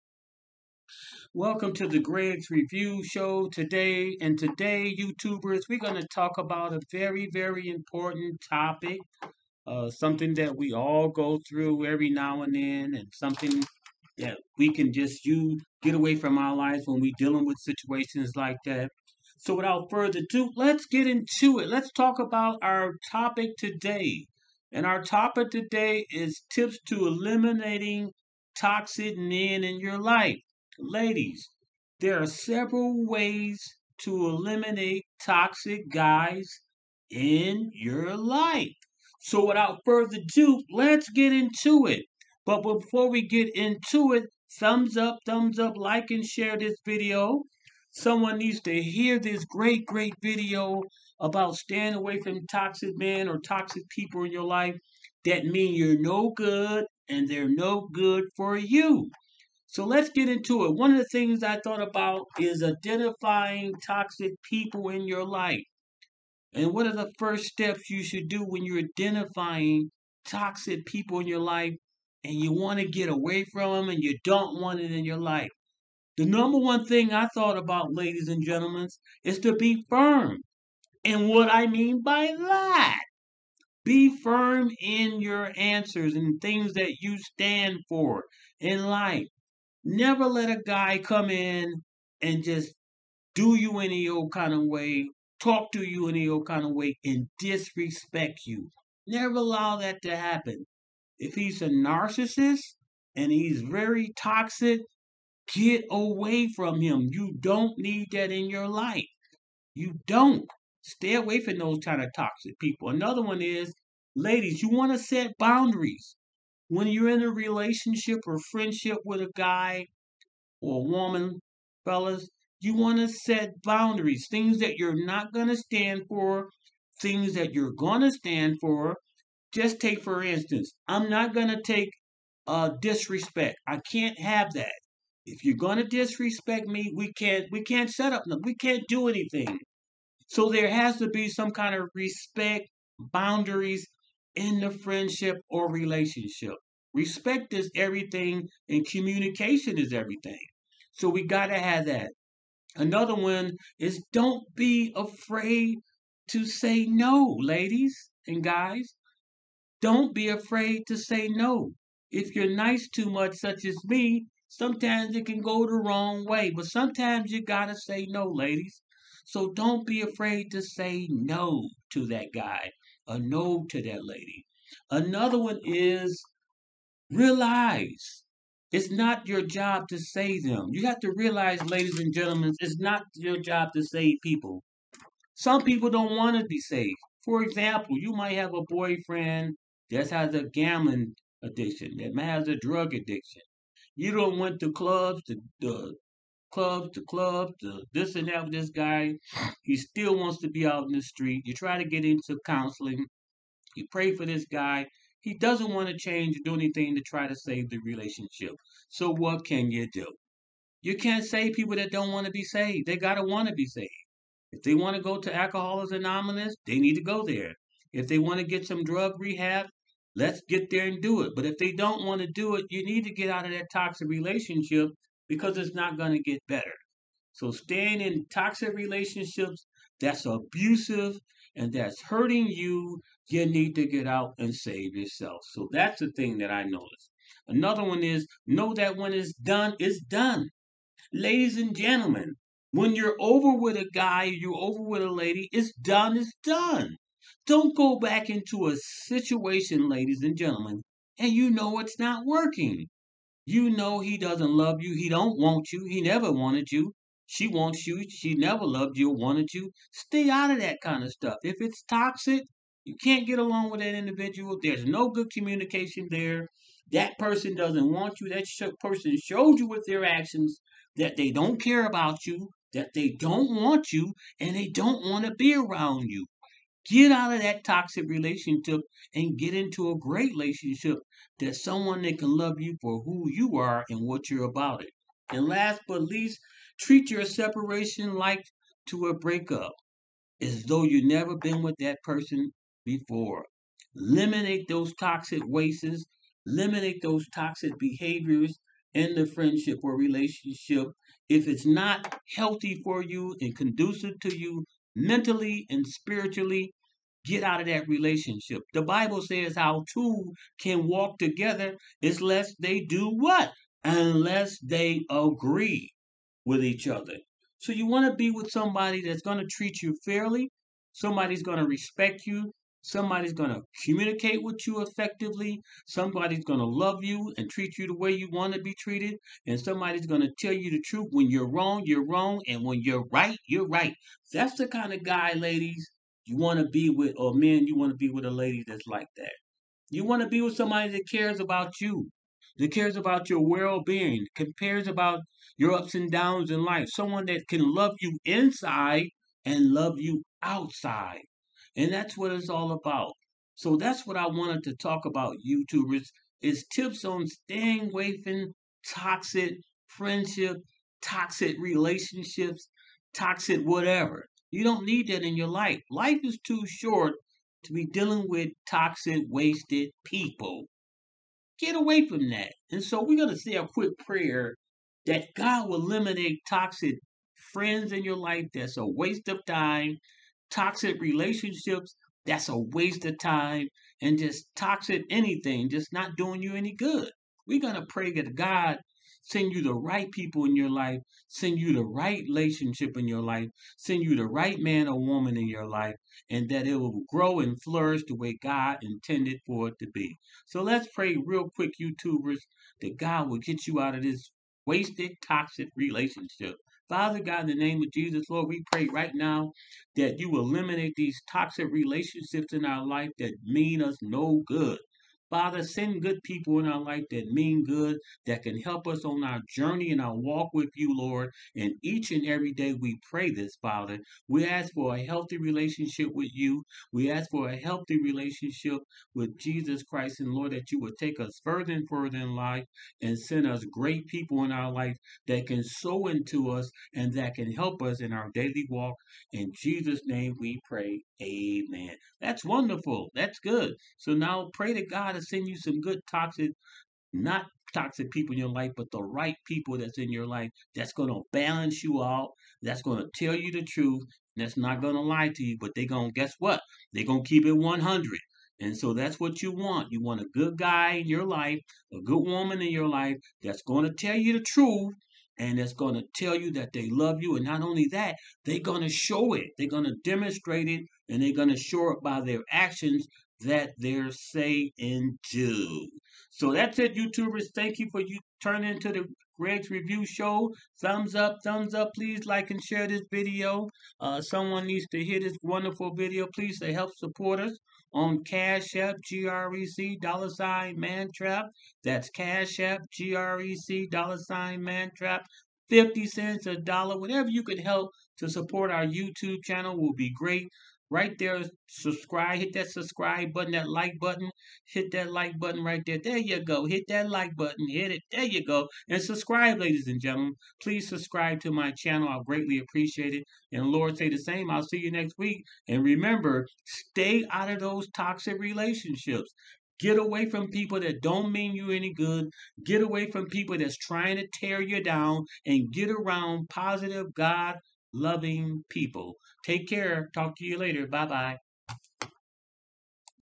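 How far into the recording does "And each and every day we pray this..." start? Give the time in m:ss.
7:01.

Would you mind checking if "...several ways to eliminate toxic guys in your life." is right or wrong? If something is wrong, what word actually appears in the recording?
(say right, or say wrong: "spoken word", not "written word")
right.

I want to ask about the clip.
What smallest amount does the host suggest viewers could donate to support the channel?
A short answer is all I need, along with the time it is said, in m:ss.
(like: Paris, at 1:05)
50 cents, at 8:15.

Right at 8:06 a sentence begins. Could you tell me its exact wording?
Please to help support us on Cash App, GREC, dollar sign, Mantrap.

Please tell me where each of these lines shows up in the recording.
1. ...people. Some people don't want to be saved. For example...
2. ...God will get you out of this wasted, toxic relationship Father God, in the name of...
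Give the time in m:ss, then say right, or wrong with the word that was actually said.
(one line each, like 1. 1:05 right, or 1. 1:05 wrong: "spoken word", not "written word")
1. 3:04 right
2. 6:42 right.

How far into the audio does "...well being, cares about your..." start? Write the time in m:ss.
5:43.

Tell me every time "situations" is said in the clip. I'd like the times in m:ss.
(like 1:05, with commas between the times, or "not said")
0:17, 4:08.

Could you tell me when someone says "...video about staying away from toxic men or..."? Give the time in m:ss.
0:50.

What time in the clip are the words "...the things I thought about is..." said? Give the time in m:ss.
1:00.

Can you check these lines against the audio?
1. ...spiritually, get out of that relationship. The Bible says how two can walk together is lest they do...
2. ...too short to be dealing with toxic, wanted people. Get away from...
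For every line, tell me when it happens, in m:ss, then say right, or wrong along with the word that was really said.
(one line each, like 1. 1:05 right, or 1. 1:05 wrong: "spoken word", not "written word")
1. 5:05 right
2. 6:06 wrong: "wasted", not "wanted".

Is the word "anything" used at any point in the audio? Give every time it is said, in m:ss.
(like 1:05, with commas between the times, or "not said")
2:19, 3:26, 6:25.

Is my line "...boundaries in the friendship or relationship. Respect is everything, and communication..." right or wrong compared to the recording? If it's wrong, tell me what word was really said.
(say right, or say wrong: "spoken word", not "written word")
right.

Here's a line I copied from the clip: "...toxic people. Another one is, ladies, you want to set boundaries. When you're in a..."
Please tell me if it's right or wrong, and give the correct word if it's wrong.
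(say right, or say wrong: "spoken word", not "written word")
right.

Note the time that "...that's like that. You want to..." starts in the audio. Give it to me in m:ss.
5:38.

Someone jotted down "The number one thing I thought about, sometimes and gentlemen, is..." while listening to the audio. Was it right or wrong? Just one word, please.
wrong.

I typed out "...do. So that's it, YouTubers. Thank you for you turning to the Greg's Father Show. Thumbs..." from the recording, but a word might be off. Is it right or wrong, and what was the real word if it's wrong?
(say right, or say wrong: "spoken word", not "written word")
wrong: "Review", not "Father".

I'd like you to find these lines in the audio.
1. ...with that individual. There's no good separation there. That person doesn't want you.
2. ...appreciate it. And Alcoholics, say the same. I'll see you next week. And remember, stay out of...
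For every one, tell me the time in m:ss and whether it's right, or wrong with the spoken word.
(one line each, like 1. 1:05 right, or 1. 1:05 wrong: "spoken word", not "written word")
1. 4:23 wrong: "communication", not "separation"
2. 8:32 wrong: "Lord", not "Alcoholics".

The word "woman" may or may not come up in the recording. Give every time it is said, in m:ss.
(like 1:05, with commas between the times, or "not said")
2:00, 6:34, 7:42.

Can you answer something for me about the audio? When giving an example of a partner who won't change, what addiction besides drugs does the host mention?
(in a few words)
Gambling addiction.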